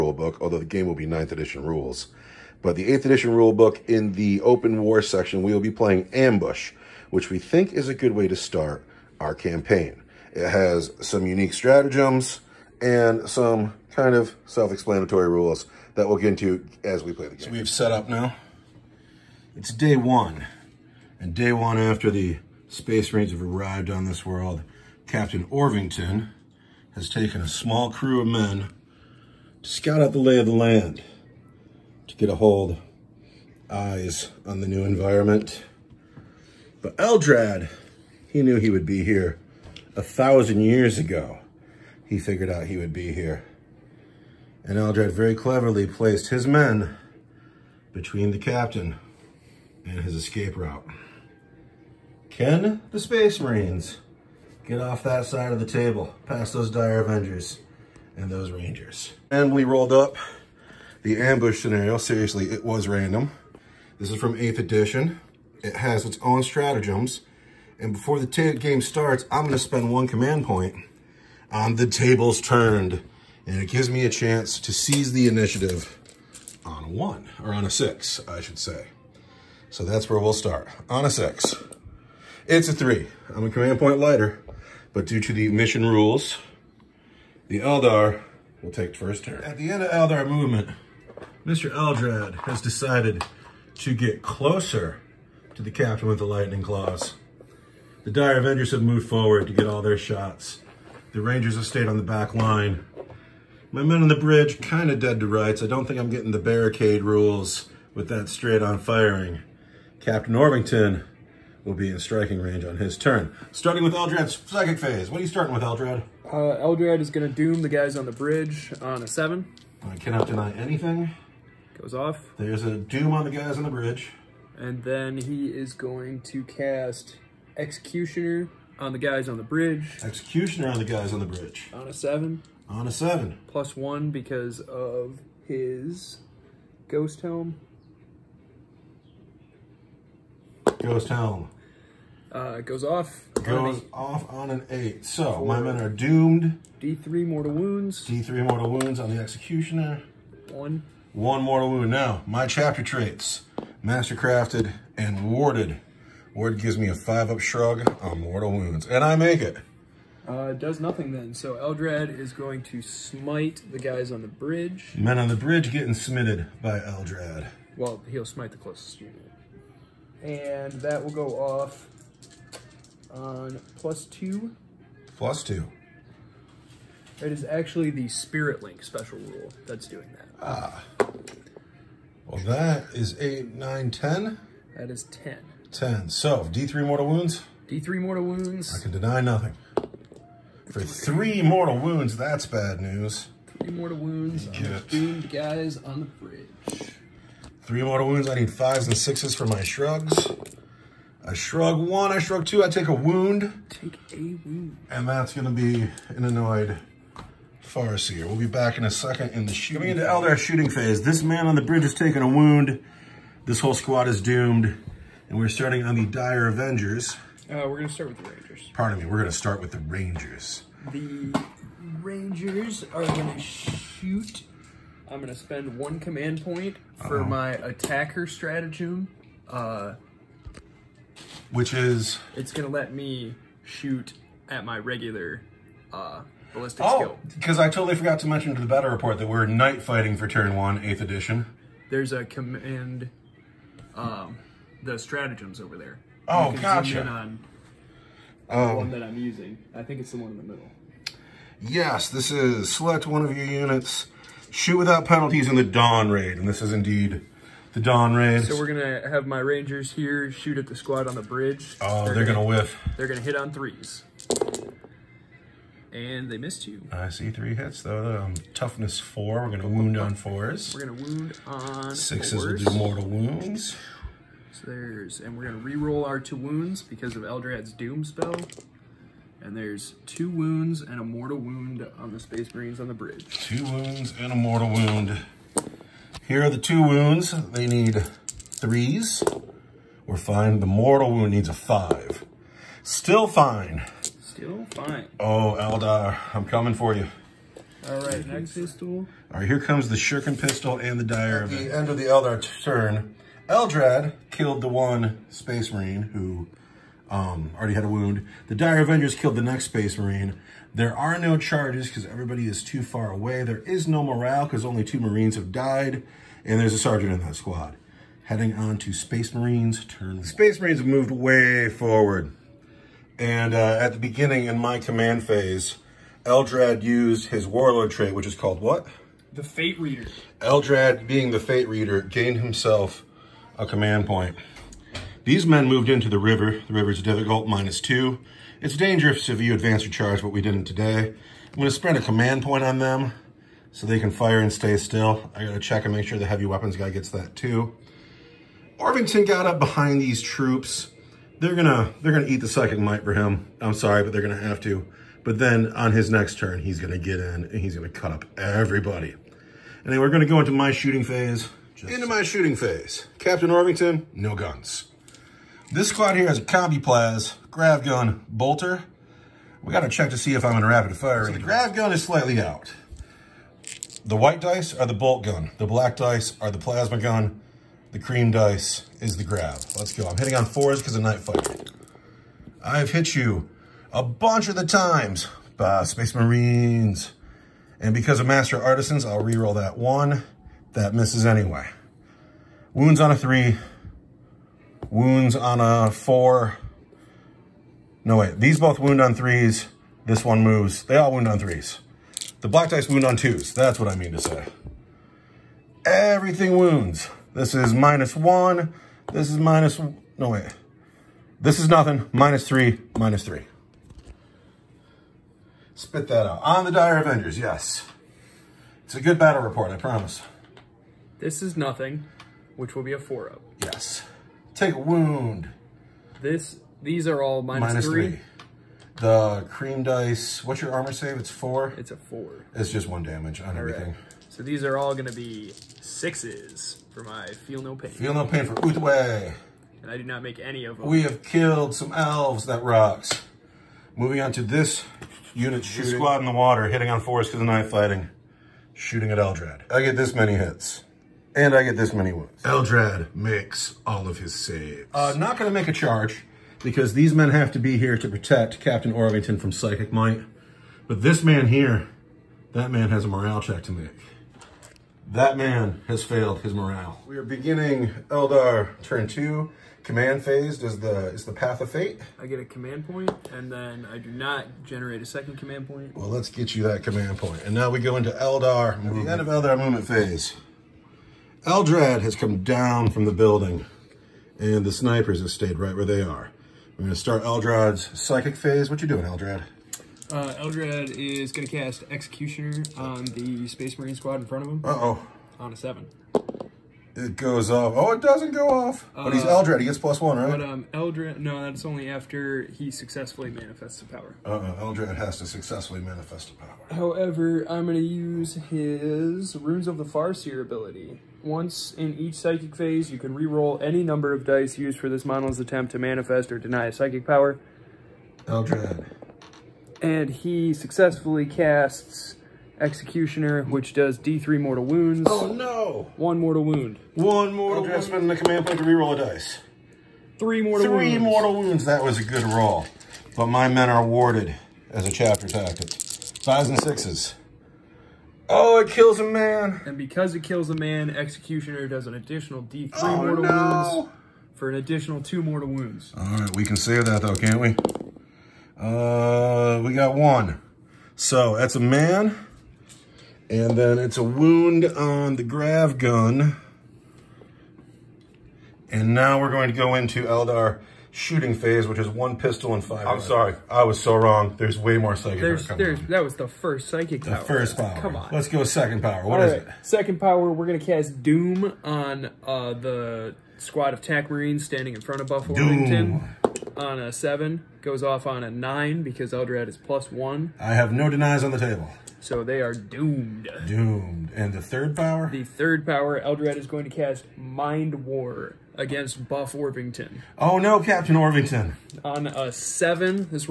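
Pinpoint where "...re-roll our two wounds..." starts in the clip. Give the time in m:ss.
4:35.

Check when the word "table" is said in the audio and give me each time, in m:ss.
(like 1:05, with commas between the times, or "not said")
0:55, 1:11, 9:41.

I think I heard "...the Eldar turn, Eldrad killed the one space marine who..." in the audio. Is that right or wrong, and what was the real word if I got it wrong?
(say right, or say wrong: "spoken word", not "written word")
right.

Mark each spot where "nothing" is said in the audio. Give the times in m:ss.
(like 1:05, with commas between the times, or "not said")
2:40, 3:09, 6:51, 7:01.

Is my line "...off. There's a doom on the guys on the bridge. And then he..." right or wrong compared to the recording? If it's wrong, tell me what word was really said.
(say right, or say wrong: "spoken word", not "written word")
right.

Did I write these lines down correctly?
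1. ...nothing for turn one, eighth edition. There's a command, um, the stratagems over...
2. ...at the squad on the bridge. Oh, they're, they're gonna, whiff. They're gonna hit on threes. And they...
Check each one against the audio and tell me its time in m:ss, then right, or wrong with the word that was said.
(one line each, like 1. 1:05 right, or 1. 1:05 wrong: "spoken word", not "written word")
1. 3:59 wrong: "fighting", not "nothing"
2. 4:20 right.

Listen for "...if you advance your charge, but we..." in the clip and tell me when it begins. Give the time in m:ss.
5:39.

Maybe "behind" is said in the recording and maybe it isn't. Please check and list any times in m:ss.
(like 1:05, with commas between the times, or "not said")
5:49.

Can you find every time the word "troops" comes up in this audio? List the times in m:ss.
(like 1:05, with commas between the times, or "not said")
5:50.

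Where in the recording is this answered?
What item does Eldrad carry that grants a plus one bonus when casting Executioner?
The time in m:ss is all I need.
2:16.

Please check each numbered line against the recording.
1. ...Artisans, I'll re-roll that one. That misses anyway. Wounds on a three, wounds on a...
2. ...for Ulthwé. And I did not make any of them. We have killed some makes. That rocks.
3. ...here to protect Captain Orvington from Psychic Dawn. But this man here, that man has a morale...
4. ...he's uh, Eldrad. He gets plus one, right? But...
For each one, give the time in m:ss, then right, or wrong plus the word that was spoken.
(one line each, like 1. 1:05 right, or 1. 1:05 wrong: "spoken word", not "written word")
1. 6:28 right
2. 7:18 wrong: "elves", not "makes"
3. 7:37 wrong: "Might", not "Dawn"
4. 8:19 right.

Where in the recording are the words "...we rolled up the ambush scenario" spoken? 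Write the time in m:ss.
0:59.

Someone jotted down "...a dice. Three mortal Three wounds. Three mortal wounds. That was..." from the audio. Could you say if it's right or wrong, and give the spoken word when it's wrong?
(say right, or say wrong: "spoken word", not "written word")
right.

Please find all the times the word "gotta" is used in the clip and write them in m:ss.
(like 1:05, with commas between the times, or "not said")
5:45, 6:09.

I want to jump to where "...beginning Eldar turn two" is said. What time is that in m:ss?
7:47.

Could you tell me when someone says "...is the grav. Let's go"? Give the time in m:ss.
6:19.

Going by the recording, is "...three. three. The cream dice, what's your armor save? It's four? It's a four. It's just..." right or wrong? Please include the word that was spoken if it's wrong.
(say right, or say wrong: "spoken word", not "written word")
right.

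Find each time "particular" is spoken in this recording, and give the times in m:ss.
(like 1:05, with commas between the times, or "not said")
not said.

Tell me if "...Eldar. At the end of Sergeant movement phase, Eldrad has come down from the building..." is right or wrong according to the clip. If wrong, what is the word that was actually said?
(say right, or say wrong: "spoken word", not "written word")
wrong: "Eldar", not "Sergeant".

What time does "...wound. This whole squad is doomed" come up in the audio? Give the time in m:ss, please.
3:32.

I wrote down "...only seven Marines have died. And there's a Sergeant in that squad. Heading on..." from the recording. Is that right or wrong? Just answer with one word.
wrong.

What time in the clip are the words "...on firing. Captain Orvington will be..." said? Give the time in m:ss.
1:48.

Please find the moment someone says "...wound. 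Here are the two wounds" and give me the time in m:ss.
4:44.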